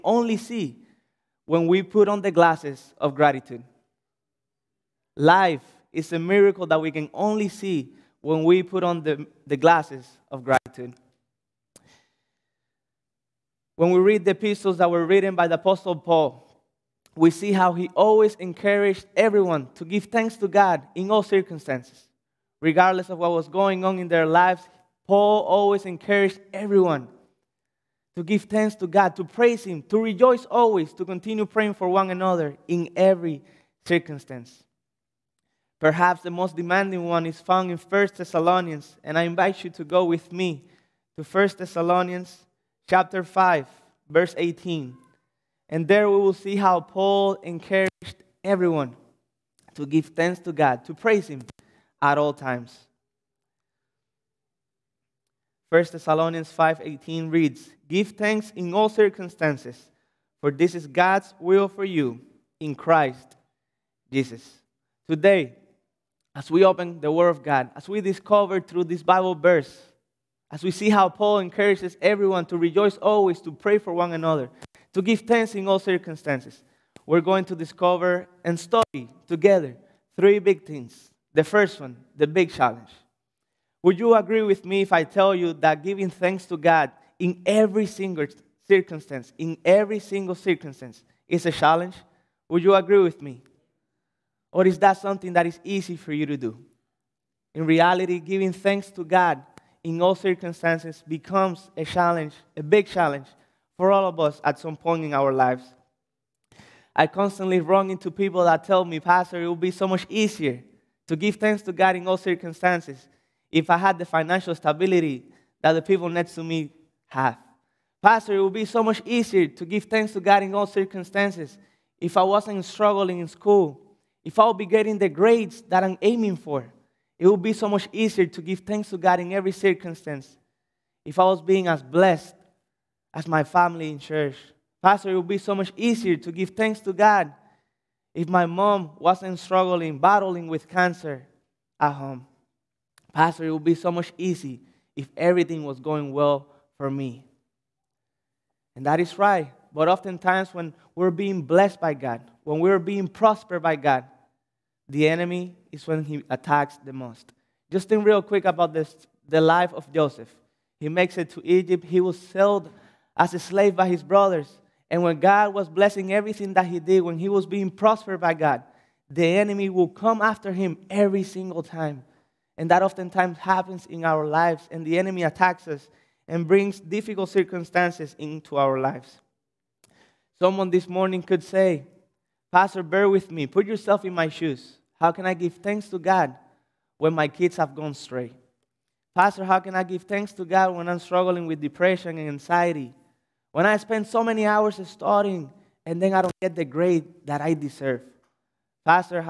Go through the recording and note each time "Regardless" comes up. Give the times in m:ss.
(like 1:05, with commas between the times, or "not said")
0:22.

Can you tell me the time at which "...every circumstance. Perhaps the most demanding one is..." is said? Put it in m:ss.
0:32.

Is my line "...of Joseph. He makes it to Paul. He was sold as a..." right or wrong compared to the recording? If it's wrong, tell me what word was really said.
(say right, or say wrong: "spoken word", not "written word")
wrong: "Egypt", not "Paul".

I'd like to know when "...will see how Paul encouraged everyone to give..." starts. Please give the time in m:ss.
0:46.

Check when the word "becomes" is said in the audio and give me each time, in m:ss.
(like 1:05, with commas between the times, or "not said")
1:41.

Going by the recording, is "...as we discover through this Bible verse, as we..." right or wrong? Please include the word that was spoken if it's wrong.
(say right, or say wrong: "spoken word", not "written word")
right.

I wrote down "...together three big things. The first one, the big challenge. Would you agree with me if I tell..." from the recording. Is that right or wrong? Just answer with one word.
right.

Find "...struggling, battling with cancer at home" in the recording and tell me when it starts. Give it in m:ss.
2:19.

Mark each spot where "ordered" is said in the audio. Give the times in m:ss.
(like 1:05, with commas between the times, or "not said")
not said.